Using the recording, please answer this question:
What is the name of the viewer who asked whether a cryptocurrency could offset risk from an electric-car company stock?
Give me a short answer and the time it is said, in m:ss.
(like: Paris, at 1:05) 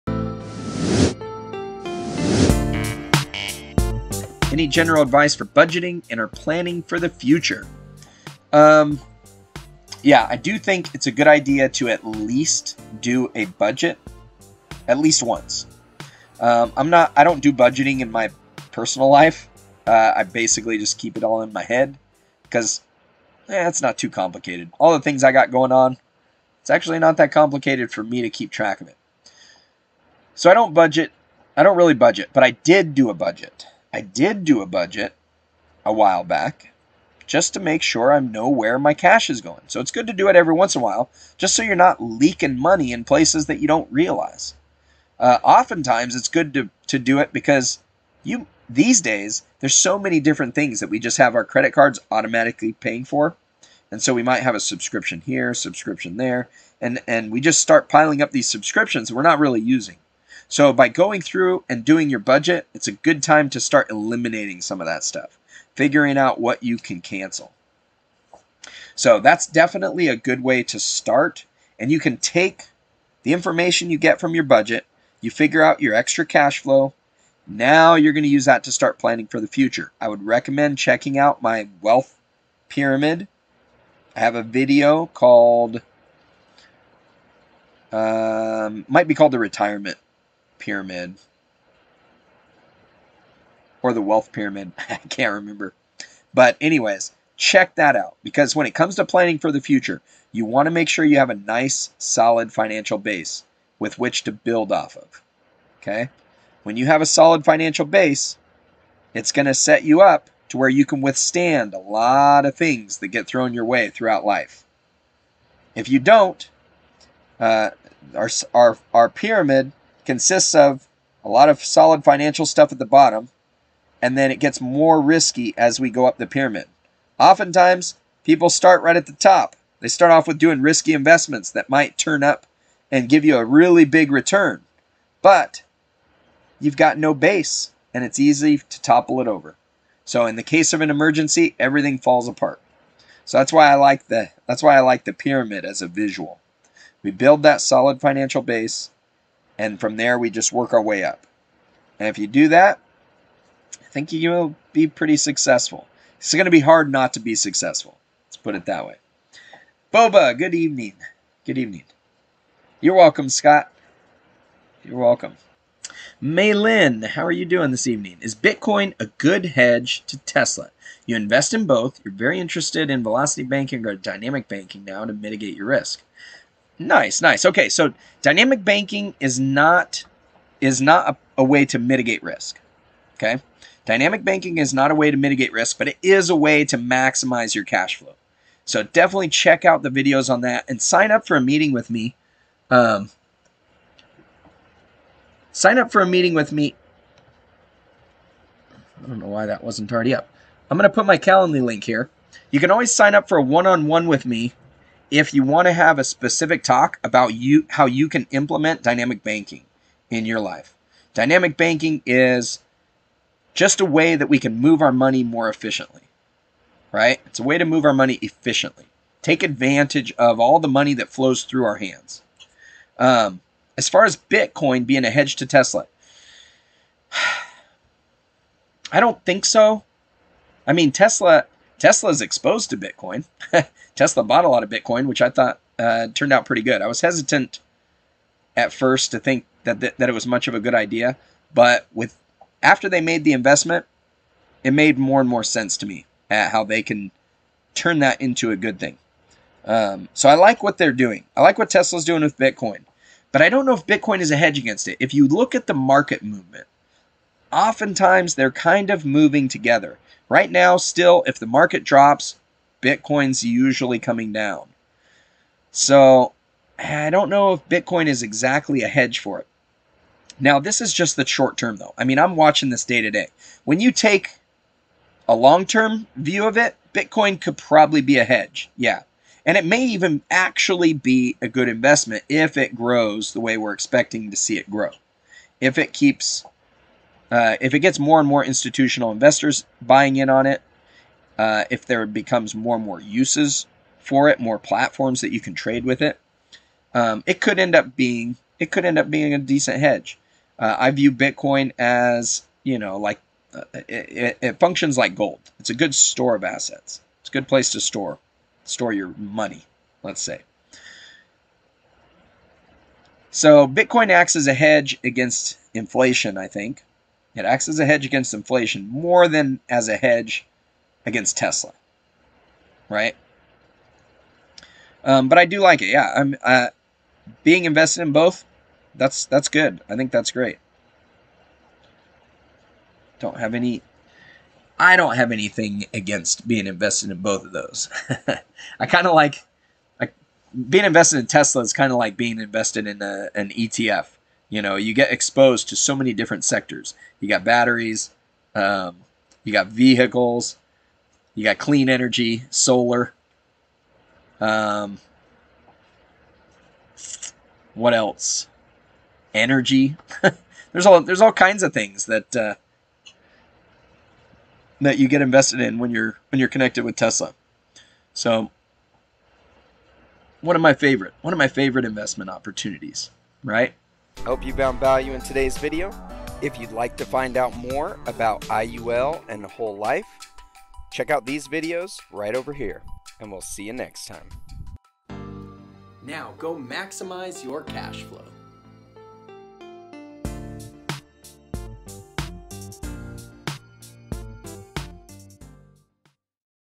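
Maylin, at 2:46.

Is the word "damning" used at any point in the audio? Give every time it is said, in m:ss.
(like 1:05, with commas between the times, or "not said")
not said.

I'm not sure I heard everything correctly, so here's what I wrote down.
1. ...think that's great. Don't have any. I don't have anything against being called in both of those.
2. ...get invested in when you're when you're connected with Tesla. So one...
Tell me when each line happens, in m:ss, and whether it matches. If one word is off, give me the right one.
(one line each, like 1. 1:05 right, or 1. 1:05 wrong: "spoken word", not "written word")
1. 5:29 wrong: "invested", not "called"
2. 6:05 right.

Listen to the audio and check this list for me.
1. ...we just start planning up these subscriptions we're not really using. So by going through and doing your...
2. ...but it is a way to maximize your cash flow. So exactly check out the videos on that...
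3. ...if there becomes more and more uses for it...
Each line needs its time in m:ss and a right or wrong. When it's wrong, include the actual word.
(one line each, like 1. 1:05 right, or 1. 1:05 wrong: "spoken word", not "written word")
1. 0:57 wrong: "piling", not "planning"
2. 3:05 wrong: "definitely", not "exactly"
3. 4:51 right.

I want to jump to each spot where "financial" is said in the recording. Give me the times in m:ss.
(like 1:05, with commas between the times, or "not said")
1:42, 1:47, 2:02, 2:28.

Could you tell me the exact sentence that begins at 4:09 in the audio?
Um, so I like what they're doing.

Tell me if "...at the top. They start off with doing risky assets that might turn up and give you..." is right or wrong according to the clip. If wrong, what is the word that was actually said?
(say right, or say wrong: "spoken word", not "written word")
wrong: "investments", not "assets".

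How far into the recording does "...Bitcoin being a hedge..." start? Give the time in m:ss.
3:44.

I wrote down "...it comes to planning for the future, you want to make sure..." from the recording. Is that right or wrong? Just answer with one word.
right.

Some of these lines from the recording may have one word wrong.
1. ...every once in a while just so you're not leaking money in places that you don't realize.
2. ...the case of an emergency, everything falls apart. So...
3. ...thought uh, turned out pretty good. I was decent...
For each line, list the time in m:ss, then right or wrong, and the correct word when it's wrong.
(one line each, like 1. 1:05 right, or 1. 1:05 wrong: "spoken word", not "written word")
1. 0:40 right
2. 2:20 right
3. 3:55 wrong: "hesitant", not "decent".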